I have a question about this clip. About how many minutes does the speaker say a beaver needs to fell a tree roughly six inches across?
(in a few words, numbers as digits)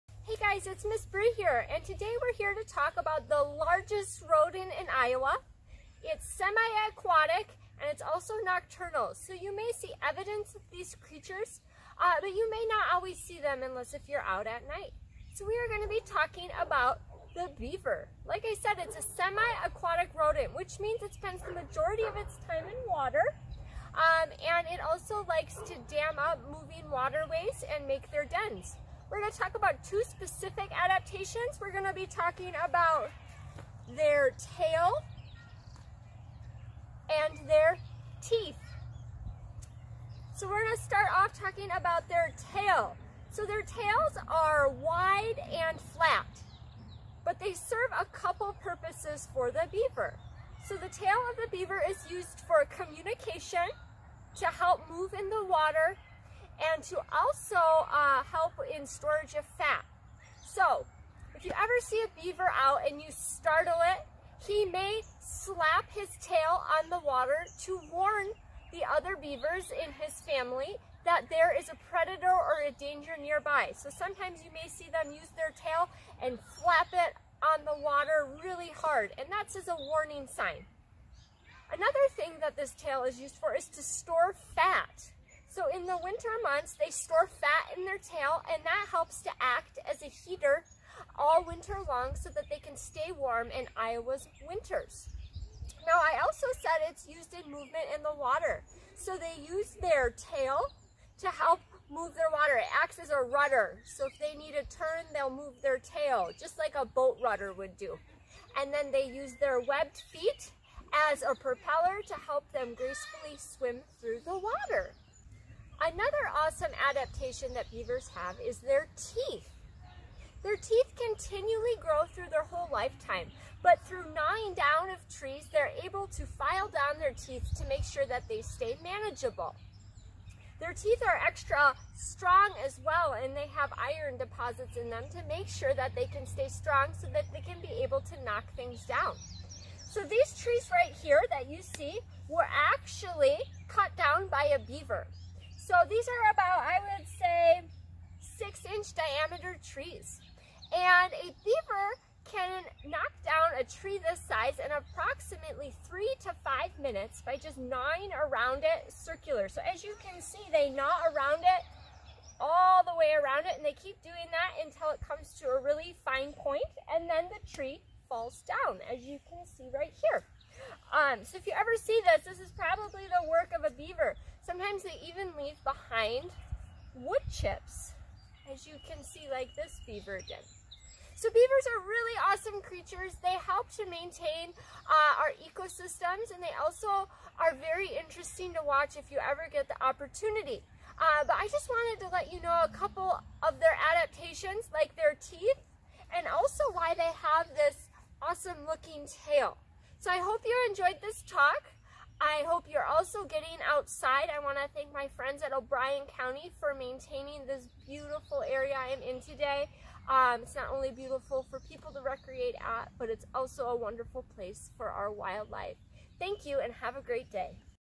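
3 to 5 minutes.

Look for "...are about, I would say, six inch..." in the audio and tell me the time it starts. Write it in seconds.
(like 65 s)
146 s.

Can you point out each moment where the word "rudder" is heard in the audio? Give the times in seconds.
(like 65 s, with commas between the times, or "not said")
103 s, 107 s.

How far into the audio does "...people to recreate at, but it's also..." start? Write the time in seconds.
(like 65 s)
211 s.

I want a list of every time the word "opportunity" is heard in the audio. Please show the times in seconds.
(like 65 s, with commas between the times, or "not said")
189 s.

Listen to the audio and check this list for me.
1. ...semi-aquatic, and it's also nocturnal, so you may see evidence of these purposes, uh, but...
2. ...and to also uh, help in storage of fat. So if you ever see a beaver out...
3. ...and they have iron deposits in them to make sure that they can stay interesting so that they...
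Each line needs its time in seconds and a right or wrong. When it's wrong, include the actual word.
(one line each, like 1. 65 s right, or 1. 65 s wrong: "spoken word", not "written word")
1. 6 s wrong: "creatures", not "purposes"
2. 56 s right
3. 133 s wrong: "strong", not "interesting".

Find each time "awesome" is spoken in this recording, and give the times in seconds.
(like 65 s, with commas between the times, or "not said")
116 s, 182 s, 198 s.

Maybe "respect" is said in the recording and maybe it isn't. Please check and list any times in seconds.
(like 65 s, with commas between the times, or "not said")
not said.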